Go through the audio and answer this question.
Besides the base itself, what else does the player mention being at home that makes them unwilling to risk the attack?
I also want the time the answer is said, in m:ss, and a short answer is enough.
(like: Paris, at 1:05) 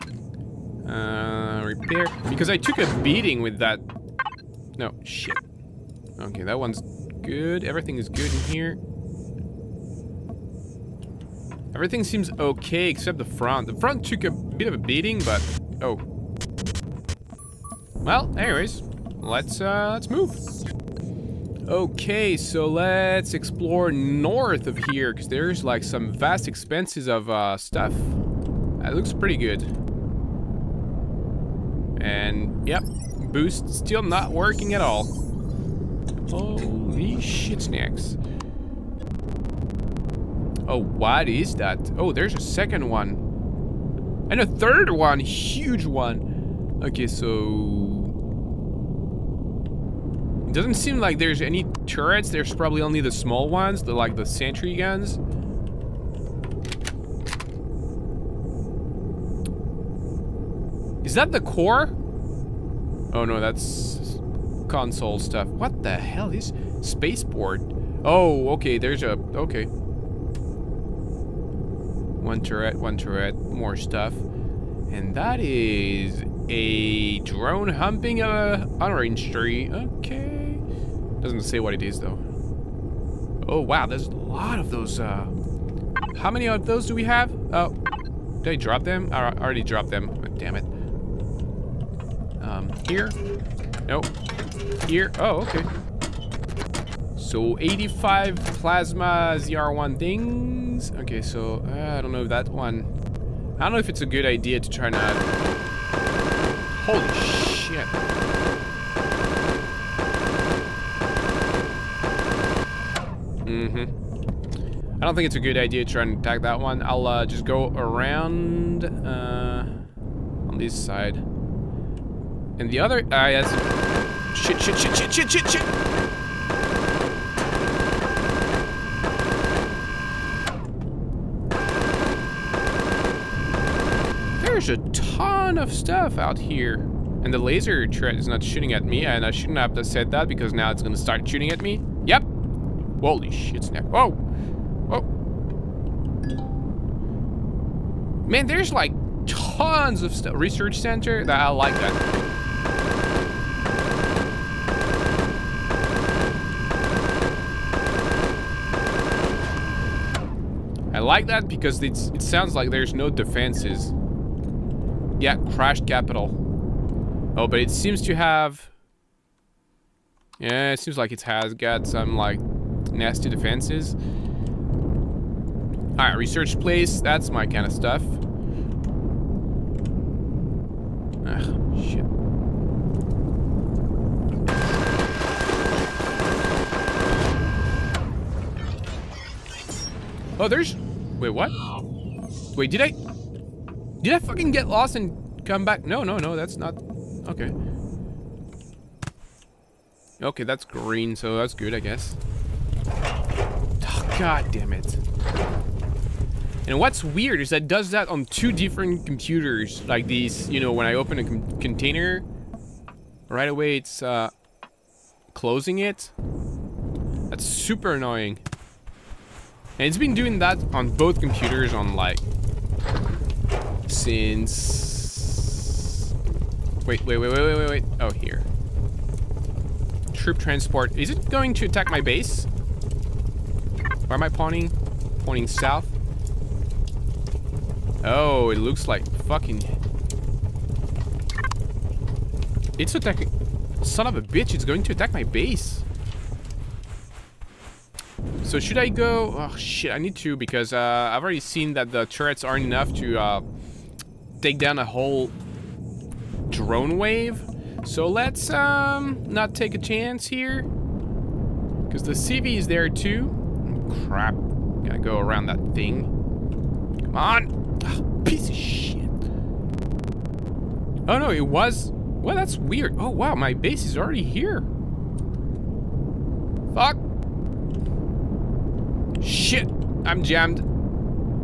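The CV, at 4:22.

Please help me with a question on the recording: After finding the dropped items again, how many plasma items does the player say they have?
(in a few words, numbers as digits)
85.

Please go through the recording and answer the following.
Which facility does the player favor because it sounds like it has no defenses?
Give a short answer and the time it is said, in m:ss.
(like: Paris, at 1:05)
Research center, at 2:30.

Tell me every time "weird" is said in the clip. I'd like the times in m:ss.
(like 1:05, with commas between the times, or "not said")
3:27, 4:32.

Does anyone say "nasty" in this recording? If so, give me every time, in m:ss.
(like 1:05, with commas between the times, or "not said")
2:52.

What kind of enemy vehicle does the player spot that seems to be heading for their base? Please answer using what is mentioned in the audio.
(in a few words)
Troop transport.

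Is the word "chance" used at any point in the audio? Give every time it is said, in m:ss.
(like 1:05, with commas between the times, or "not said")
4:19.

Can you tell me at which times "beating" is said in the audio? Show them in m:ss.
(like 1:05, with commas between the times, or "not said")
0:02, 0:14.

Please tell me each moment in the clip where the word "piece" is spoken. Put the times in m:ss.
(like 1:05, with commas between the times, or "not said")
4:28.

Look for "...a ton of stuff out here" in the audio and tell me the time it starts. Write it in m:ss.
2:14.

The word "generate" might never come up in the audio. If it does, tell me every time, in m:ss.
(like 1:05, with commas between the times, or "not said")
not said.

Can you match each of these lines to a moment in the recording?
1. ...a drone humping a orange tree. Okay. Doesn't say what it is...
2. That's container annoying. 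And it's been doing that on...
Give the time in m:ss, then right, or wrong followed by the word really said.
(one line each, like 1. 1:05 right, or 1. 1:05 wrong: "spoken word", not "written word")
1. 1:16 right
2. 3:37 wrong: "super", not "container".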